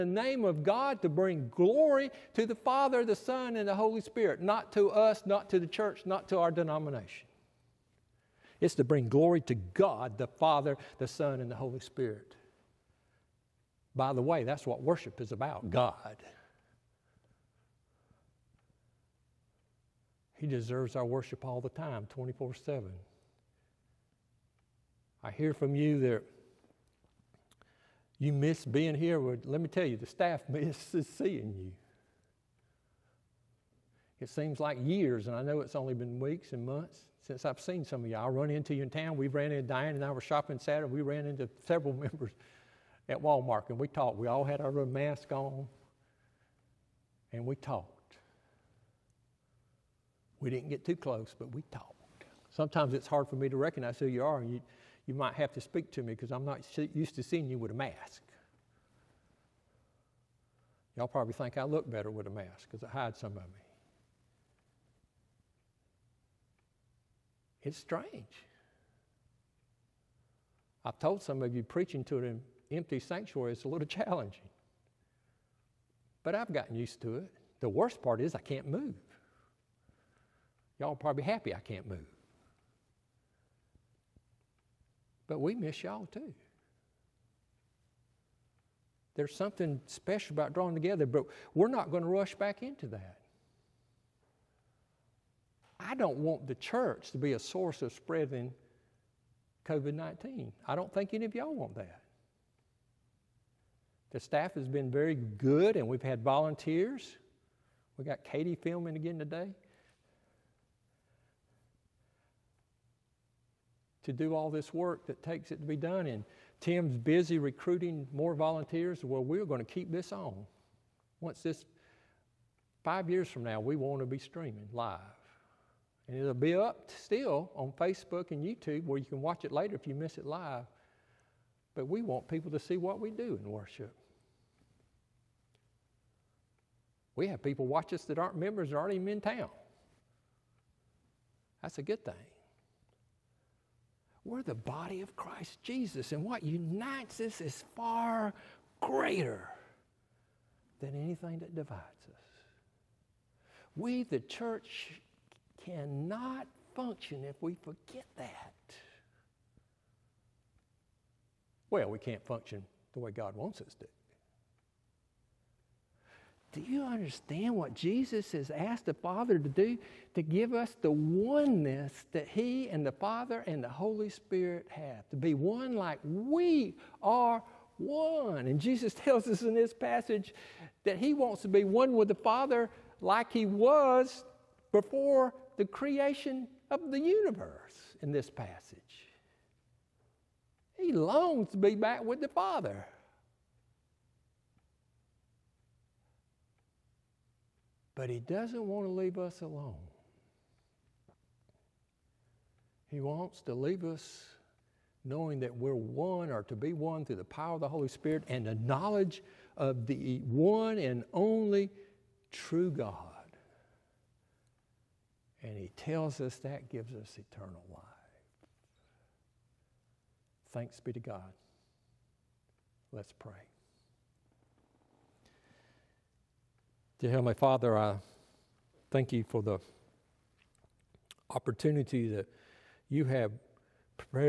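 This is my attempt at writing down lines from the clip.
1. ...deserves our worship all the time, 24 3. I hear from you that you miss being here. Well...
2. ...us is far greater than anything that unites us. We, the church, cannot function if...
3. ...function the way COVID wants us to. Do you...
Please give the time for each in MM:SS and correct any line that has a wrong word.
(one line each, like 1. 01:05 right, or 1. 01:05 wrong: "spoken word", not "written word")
1. 00:20 wrong: "7", not "3"
2. 02:27 wrong: "divides", not "unites"
3. 02:42 wrong: "God", not "COVID".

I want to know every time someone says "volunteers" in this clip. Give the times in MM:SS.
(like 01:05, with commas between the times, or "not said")
01:46, 01:58.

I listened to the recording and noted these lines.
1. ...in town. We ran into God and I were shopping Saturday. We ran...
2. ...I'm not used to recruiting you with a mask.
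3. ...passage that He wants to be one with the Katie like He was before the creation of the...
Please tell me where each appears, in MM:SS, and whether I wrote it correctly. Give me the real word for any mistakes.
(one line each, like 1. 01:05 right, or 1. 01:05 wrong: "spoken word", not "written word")
1. 00:38 wrong: "Diane", not "God"
2. 00:56 wrong: "seeing", not "recruiting"
3. 02:59 wrong: "Father", not "Katie".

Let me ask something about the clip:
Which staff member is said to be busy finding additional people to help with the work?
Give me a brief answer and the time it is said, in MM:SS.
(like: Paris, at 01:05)
Tim, at 01:56.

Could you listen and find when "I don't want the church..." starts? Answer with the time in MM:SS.
01:35.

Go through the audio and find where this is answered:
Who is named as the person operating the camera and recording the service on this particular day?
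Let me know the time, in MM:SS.
01:48.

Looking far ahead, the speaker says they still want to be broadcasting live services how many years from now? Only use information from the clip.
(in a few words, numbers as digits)
5.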